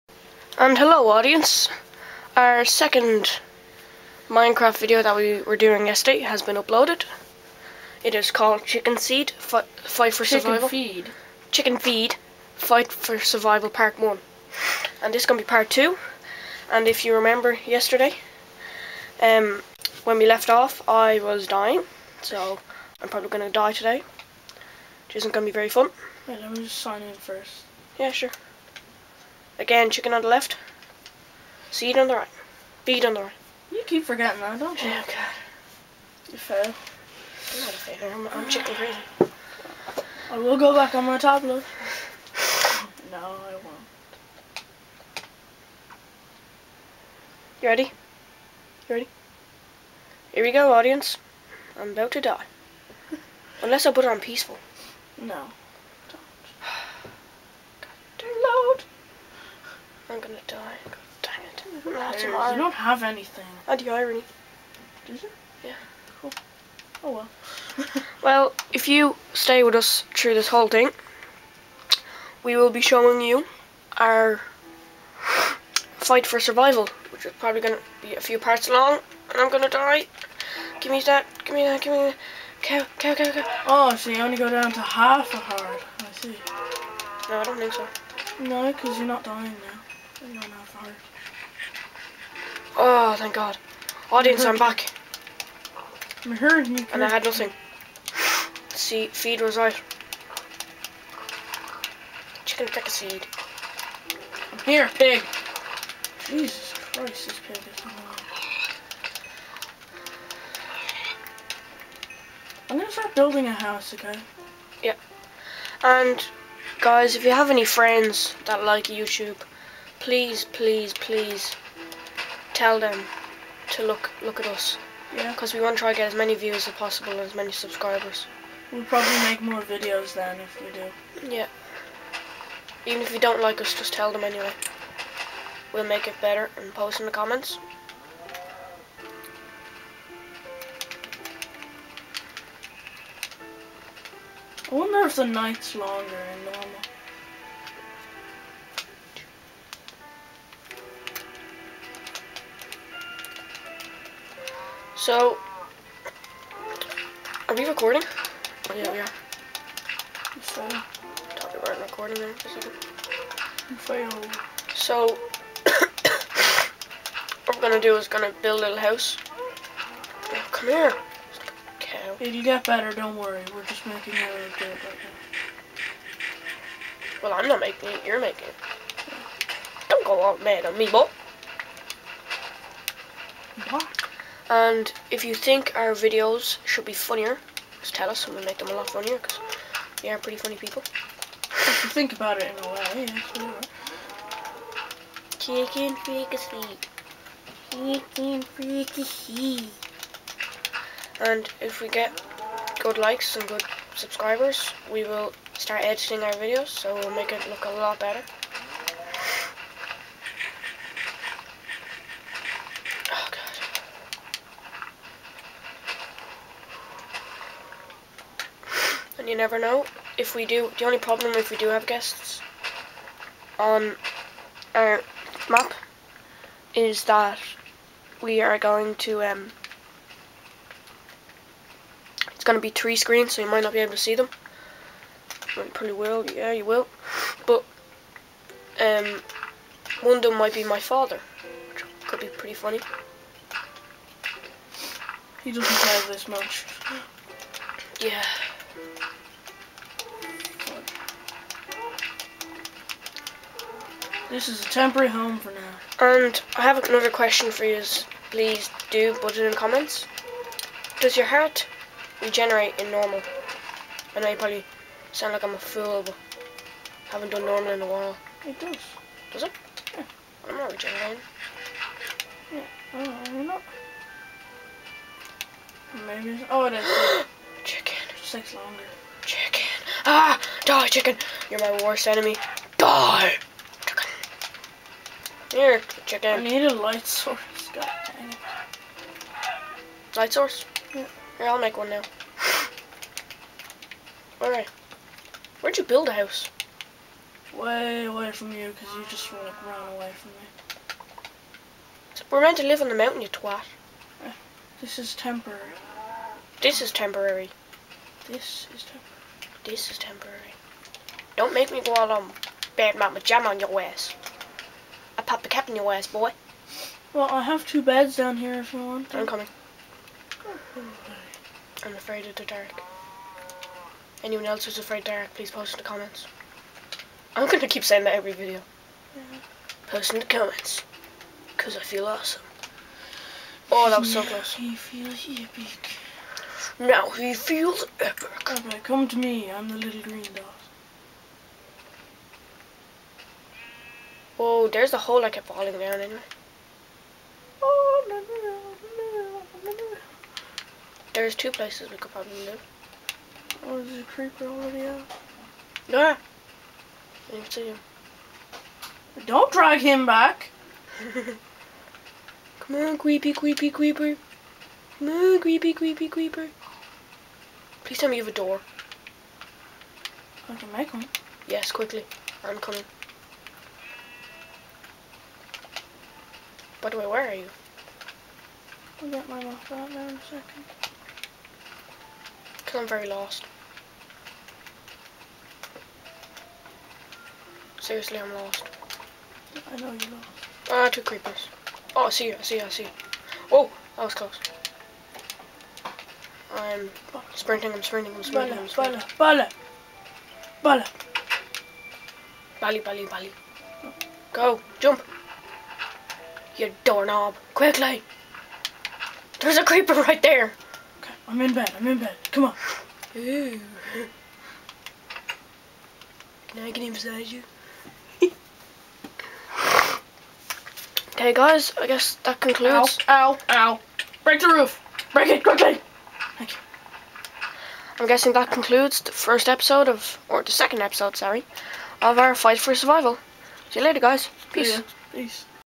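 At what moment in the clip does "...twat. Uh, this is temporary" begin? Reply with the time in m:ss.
5:03.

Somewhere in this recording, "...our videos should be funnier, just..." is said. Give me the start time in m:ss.
3:05.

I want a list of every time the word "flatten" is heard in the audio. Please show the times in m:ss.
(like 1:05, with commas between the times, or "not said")
not said.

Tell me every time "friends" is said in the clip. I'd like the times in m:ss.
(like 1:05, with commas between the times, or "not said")
1:57.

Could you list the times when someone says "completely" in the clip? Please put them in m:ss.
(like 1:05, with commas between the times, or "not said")
not said.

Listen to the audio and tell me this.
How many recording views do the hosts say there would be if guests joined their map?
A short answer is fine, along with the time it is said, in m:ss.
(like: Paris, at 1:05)
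3, at 3:52.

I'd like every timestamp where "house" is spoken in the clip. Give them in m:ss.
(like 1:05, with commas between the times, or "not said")
1:53, 2:48, 4:56.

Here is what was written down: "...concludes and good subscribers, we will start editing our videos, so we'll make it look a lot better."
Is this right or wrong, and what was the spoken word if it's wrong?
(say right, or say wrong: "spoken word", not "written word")
wrong: "likes", not "concludes".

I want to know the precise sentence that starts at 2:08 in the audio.
We'll probably make more videos then if we do.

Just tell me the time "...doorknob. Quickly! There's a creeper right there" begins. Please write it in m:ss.
6:46.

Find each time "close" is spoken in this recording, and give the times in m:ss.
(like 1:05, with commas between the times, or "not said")
5:34, 6:34.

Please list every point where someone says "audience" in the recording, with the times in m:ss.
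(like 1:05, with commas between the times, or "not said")
0:01, 0:50, 1:34.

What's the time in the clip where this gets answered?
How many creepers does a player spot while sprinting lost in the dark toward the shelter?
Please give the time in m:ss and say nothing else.
6:30.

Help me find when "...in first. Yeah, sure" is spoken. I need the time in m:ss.
0:27.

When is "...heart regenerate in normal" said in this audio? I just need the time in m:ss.
4:21.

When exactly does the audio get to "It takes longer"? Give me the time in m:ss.
4:38.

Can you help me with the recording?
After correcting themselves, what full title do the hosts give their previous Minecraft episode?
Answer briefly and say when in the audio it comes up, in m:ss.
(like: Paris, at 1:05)
Chicken Feed, Fight for Survival Part 1, at 0:11.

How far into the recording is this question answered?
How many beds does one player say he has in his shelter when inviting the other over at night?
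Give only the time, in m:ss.
5:17.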